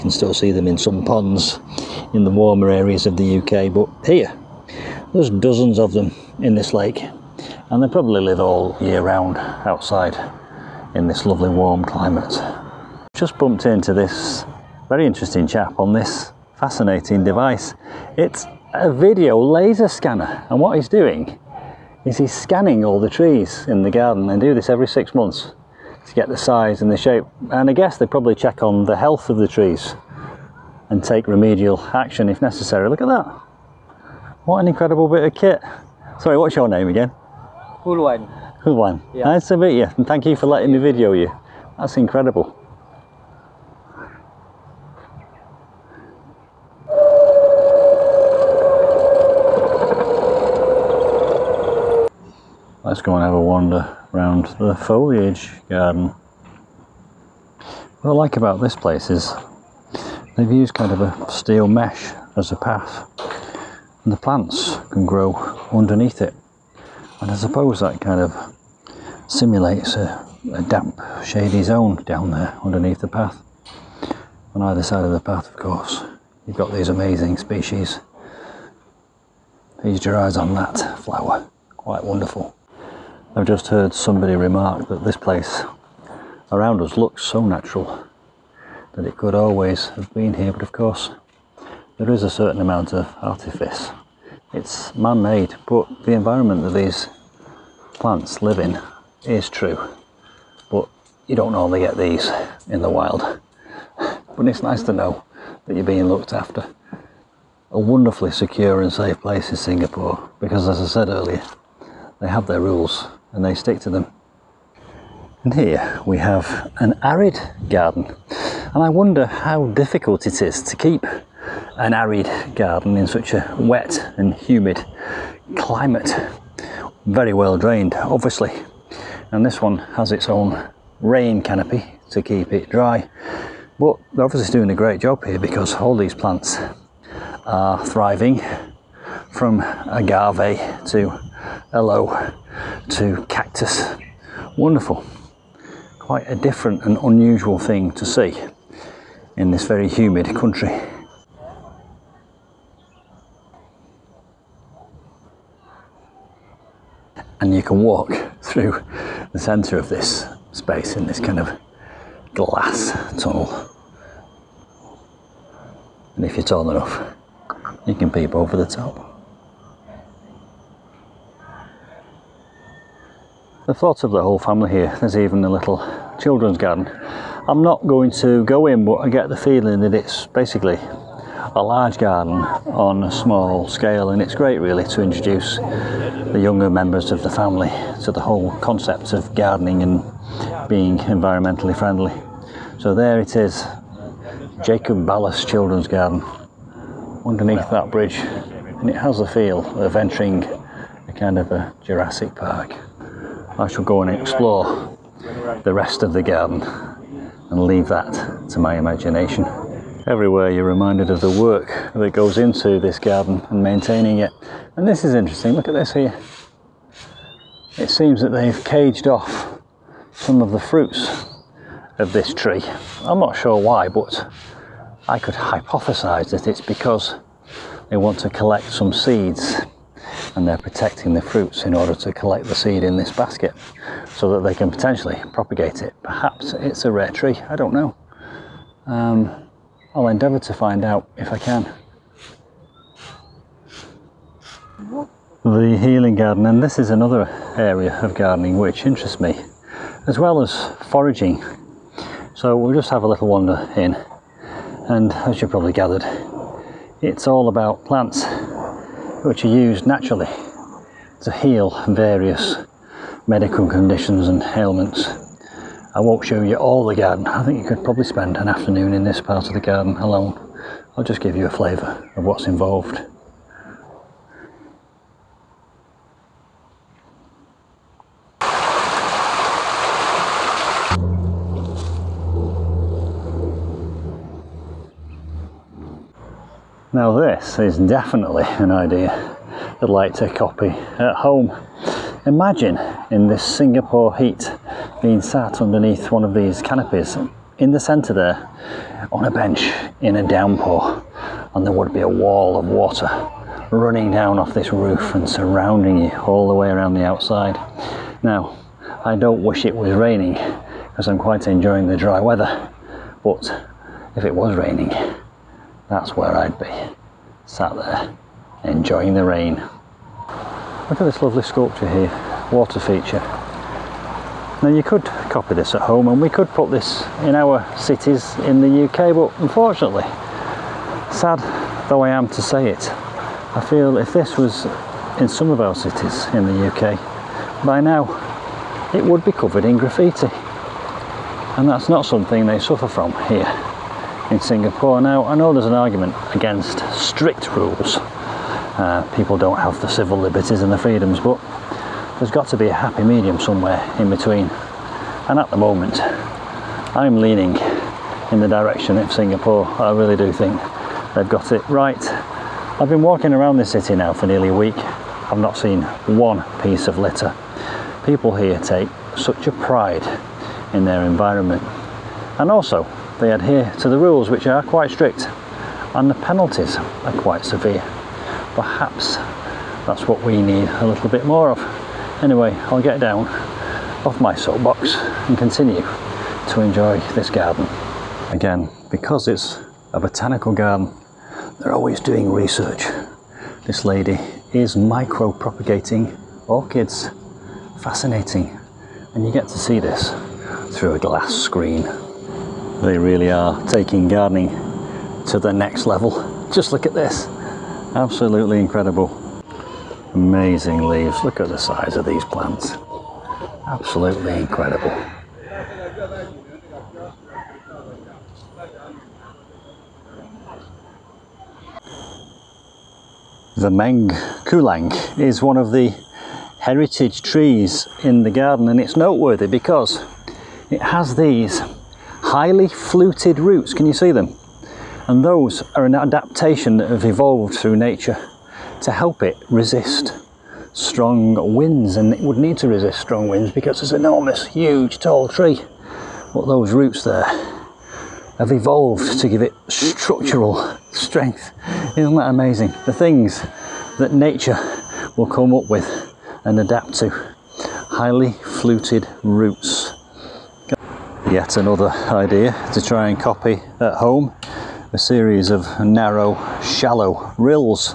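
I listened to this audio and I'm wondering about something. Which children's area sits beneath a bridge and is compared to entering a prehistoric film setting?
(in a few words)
Jacob Ballas Children's Garden.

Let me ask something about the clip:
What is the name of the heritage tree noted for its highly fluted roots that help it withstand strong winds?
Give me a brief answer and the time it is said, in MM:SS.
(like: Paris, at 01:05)
Meng Kulang, at 07:03.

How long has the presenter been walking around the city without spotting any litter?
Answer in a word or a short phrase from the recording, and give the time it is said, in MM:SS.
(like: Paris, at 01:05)
Nearly a week, at 06:04.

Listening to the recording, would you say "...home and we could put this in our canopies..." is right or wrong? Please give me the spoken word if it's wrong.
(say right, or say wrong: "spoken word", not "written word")
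wrong: "cities", not "canopies".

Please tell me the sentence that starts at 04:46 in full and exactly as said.
Now this is definitely an idea I'd like to copy at home.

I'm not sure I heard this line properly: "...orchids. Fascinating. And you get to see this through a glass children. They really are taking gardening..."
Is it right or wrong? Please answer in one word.
wrong.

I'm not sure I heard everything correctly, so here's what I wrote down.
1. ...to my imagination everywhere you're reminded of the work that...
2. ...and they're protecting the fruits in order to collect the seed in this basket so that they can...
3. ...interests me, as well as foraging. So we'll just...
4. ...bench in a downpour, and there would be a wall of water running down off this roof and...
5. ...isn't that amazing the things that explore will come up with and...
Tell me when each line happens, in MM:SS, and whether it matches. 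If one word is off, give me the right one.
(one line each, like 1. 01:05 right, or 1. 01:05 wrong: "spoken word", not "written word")
1. 03:28 right
2. 03:50 right
3. 04:08 right
4. 04:59 right
5. 07:31 wrong: "nature", not "explore".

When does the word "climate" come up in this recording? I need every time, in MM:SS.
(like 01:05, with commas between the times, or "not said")
00:11, 02:05.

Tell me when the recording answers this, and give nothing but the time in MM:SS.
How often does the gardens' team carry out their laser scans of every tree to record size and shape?
00:24.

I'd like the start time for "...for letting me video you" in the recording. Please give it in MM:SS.
00:40.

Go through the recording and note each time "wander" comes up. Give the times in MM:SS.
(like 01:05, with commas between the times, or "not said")
00:53, 04:13.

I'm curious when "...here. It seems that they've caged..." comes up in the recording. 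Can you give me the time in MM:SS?
03:35.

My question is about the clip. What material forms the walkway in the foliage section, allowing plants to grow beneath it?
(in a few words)
Steel mesh.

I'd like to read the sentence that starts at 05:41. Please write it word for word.
And that's not something they suffer from here in Singapore.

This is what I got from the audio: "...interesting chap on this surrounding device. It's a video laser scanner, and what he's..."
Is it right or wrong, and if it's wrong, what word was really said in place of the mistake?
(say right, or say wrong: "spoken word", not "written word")
wrong: "fascinating", not "surrounding".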